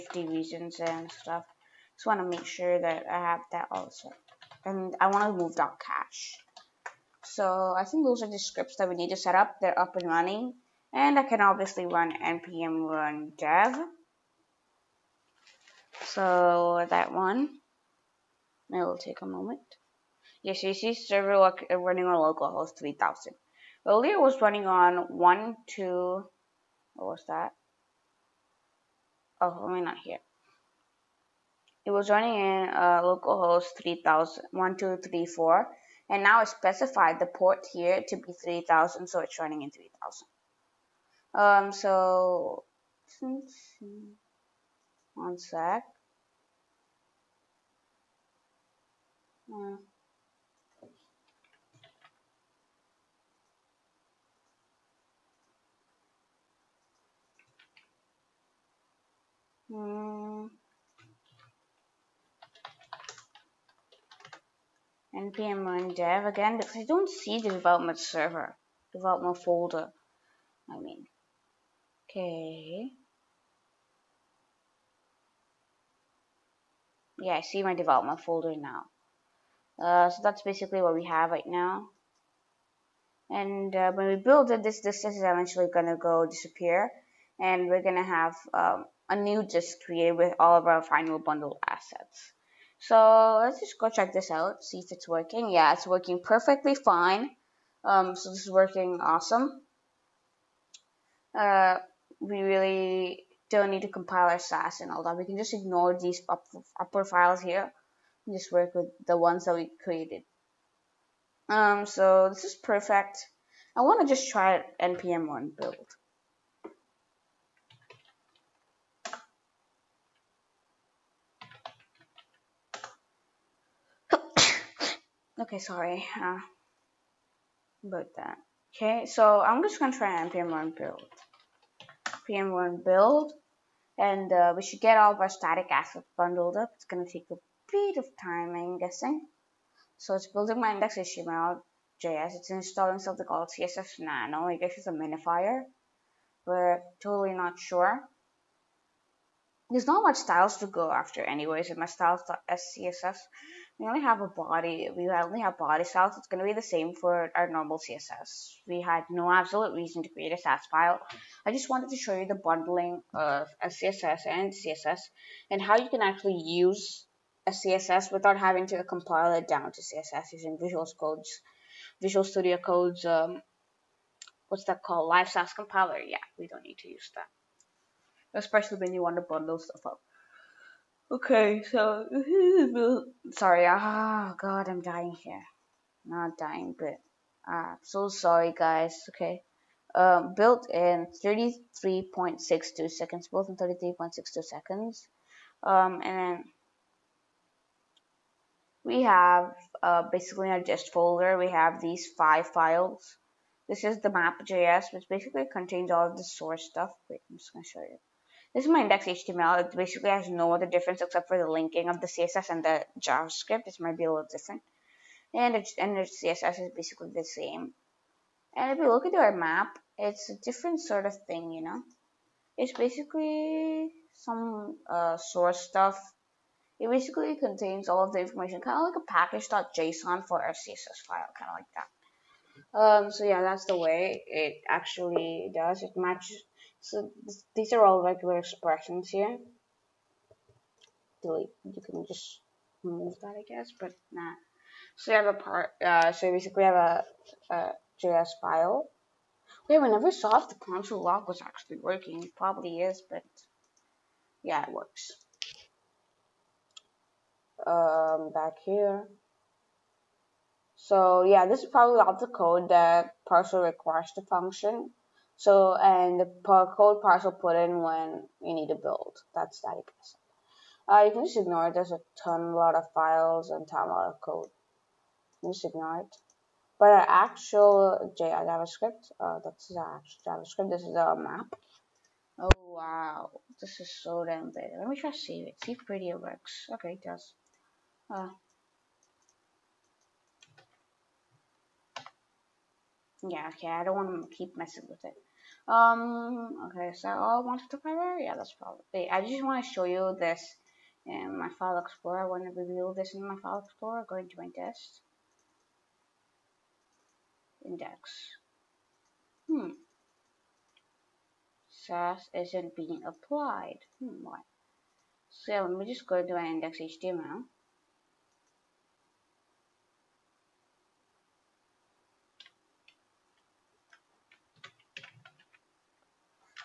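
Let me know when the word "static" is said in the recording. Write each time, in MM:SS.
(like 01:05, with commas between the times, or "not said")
02:15, 04:29.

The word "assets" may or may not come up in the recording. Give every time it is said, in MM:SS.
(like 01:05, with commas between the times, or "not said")
01:31, 02:15, 04:30.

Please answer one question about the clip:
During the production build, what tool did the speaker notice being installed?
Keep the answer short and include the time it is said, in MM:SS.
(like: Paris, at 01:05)
cssnano, at 02:23.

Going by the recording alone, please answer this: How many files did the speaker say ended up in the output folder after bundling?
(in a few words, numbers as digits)
5.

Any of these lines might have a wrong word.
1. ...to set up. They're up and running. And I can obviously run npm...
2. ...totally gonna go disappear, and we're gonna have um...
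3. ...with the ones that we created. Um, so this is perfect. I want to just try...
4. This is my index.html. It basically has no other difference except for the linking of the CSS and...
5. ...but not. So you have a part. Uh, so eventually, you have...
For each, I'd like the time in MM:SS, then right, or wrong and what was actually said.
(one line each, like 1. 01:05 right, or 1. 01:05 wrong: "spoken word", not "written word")
1. 00:09 right
2. 01:25 wrong: "eventually", not "totally"
3. 01:48 right
4. 03:28 right
5. 04:03 wrong: "basically", not "eventually".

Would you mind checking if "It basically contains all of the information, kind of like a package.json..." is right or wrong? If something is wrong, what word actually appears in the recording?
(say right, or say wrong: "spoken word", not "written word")
right.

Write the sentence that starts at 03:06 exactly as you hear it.
Not dying, but ah, I'm so sorry, guys.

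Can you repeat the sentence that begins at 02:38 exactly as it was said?
We had no absolute reason to create a Sass file.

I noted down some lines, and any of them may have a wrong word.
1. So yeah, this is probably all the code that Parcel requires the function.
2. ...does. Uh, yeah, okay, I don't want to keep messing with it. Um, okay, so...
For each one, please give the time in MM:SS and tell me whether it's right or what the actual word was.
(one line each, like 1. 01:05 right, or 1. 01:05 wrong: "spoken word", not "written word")
1. 04:20 right
2. 04:47 right.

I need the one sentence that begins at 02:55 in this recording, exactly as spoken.
Yeah, we don't need to use that, especially when you want to bundle stuff up.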